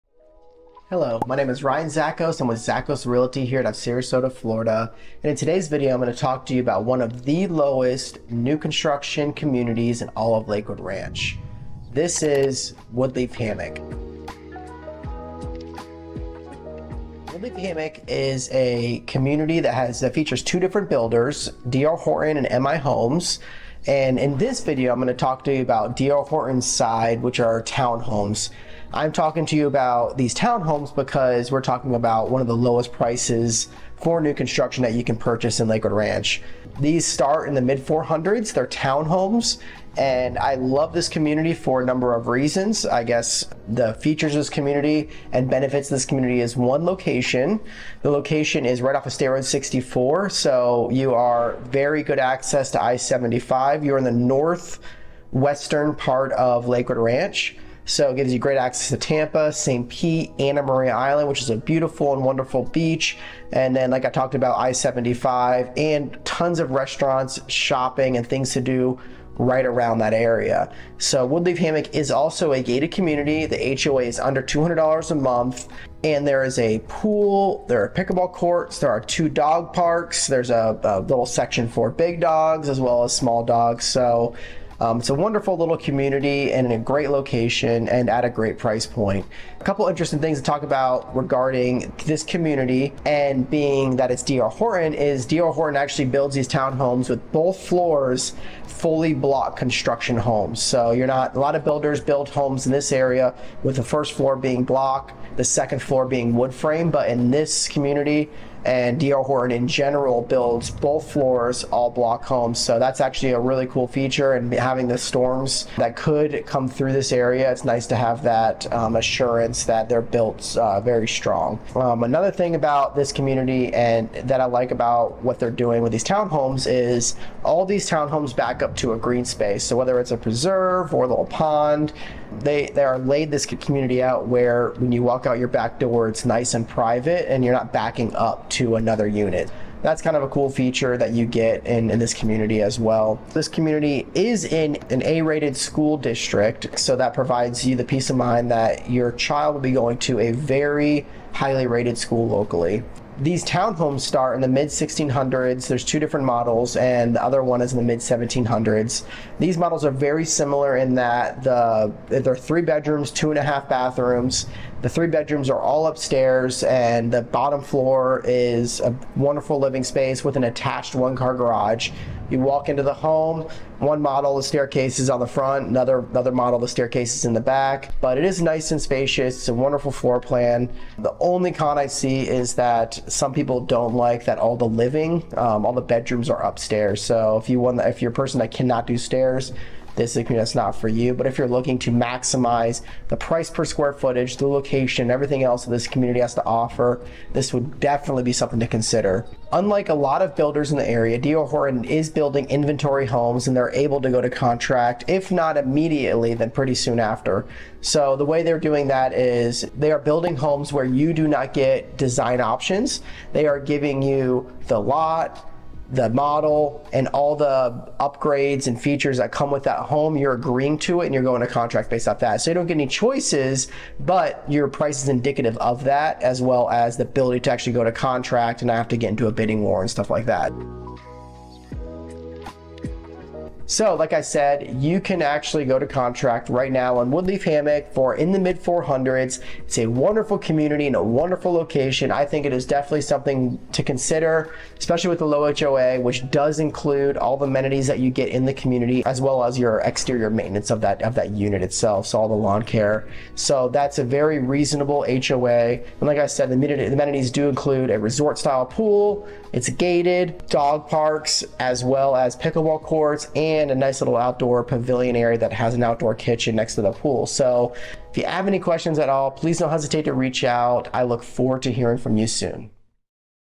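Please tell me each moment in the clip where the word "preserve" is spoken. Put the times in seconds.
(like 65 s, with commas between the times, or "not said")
130 s.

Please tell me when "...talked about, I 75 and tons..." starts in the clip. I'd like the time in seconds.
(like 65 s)
64 s.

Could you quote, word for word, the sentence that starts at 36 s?
These start in the mid 400s, they're townhomes.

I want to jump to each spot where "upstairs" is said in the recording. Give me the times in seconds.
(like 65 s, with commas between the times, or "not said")
165 s, 186 s.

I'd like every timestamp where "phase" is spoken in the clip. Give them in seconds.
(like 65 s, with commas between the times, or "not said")
not said.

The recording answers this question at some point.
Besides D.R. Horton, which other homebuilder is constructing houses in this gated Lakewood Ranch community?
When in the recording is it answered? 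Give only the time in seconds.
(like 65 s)
22 s.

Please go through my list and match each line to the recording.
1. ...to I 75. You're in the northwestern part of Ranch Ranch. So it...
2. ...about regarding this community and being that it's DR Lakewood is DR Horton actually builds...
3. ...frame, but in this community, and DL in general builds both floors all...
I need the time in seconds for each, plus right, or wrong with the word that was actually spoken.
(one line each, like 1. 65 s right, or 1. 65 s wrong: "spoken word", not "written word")
1. 52 s wrong: "Lakewood", not "Ranch"
2. 90 s wrong: "Horton", not "Lakewood"
3. 106 s right.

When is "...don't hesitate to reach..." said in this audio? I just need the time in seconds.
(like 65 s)
269 s.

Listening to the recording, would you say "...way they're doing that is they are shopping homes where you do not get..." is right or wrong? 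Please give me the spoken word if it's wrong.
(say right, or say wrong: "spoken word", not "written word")
wrong: "building", not "shopping".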